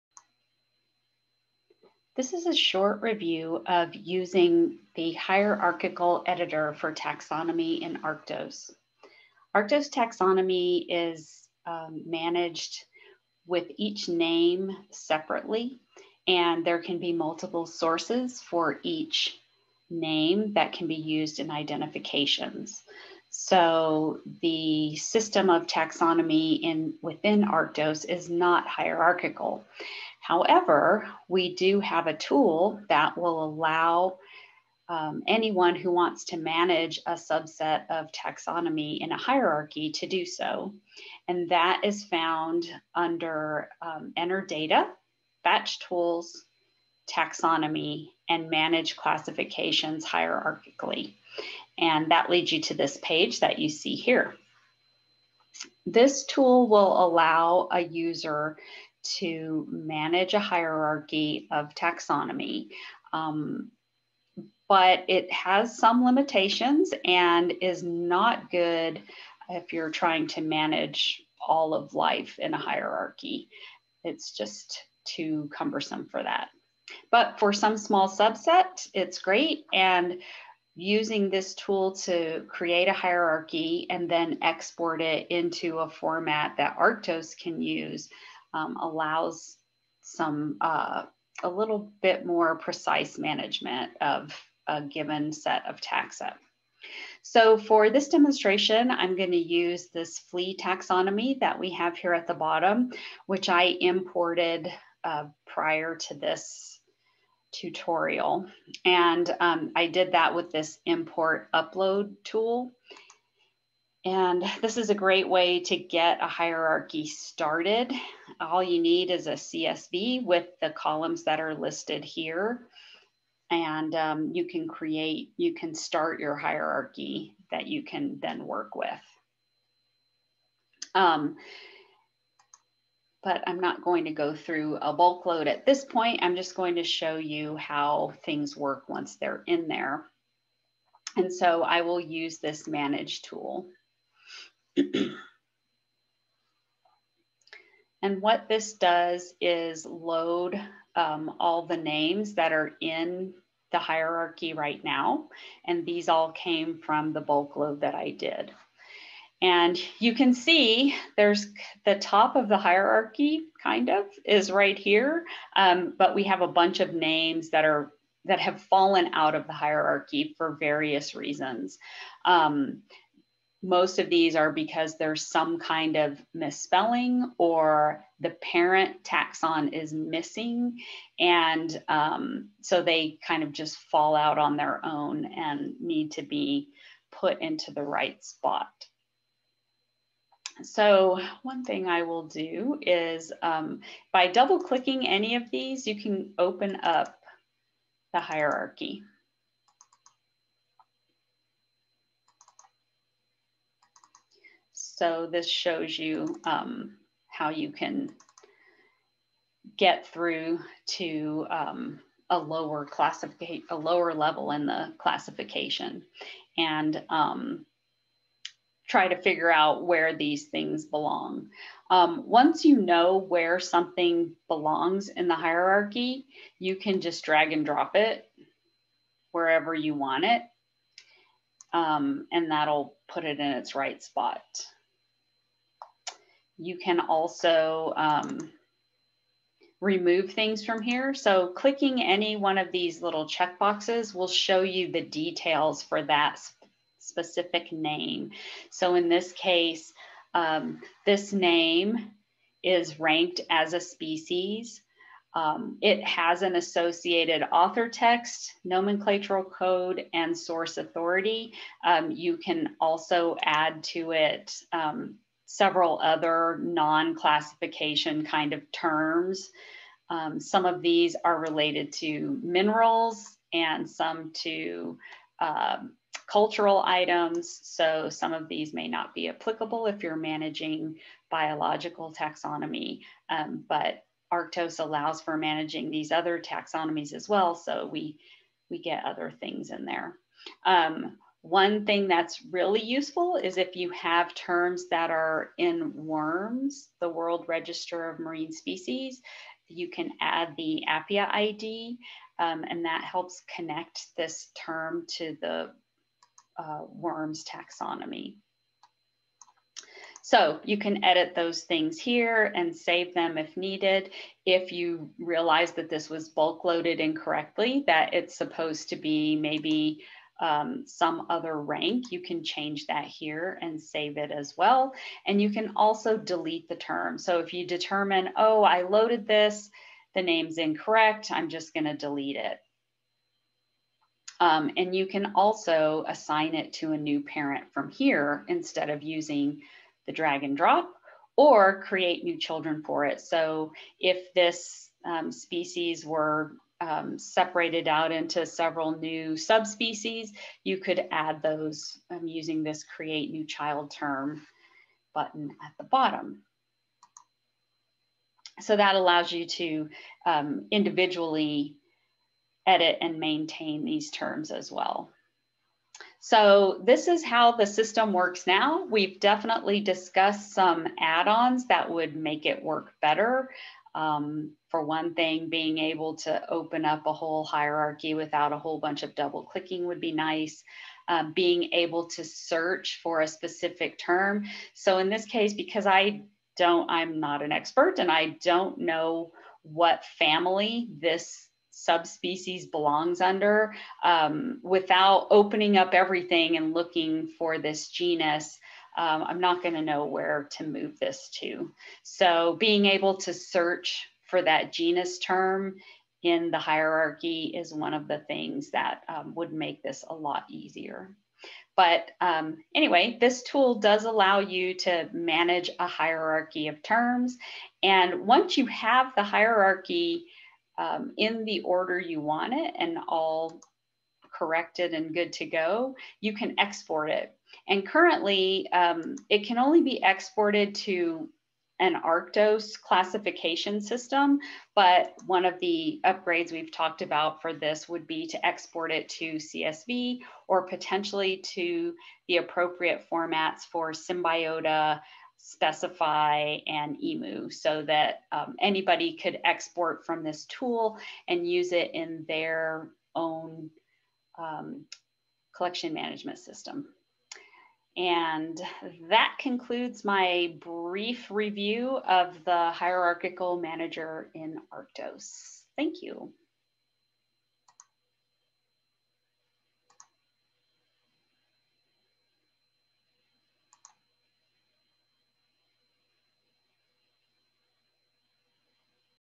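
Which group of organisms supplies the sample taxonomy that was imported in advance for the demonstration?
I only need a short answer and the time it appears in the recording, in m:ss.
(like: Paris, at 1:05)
Flea, at 1:40.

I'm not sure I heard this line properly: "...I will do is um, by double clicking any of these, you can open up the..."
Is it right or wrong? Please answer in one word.
right.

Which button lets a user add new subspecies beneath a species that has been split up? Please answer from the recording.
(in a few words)
Create new child term.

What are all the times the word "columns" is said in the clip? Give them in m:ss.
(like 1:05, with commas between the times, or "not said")
2:00.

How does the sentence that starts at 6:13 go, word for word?
Um, for one thing, being able to open up a whole hierarchy without a whole bunch of double clicking would be nice.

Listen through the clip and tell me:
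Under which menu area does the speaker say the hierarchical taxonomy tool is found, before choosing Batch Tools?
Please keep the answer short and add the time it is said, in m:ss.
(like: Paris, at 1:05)
Enter Data, at 0:44.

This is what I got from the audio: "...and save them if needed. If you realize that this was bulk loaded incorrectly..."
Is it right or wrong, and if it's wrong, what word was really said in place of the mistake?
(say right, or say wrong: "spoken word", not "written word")
right.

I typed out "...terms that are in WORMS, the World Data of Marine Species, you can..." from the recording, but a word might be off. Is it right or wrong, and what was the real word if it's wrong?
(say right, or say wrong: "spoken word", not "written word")
wrong: "Register", not "Data".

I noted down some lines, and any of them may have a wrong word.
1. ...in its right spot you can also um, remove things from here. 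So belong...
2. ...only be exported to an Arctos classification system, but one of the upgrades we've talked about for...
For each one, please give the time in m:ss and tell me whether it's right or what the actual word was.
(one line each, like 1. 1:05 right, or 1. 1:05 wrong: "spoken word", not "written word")
1. 3:53 wrong: "clicking", not "belong"
2. 7:09 right.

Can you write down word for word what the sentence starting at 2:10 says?
Um, but I'm not going to go through a bulk load at this point.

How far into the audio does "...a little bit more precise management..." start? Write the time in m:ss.
1:31.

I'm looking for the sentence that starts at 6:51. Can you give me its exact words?
But um, anyway, this tool does allow you to manage a hierarchy of terms.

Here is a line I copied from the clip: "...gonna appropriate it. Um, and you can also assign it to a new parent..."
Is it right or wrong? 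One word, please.
wrong.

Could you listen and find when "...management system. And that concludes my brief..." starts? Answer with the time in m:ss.
7:35.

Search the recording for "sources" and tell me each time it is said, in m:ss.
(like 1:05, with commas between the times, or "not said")
0:17, 4:20.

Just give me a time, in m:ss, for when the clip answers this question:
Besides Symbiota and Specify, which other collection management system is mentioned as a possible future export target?
7:27.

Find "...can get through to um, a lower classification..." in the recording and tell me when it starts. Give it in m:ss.
3:27.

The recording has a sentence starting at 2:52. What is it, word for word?
Um, most of these are because there's some kind of misspelling or the parent taxon is missing.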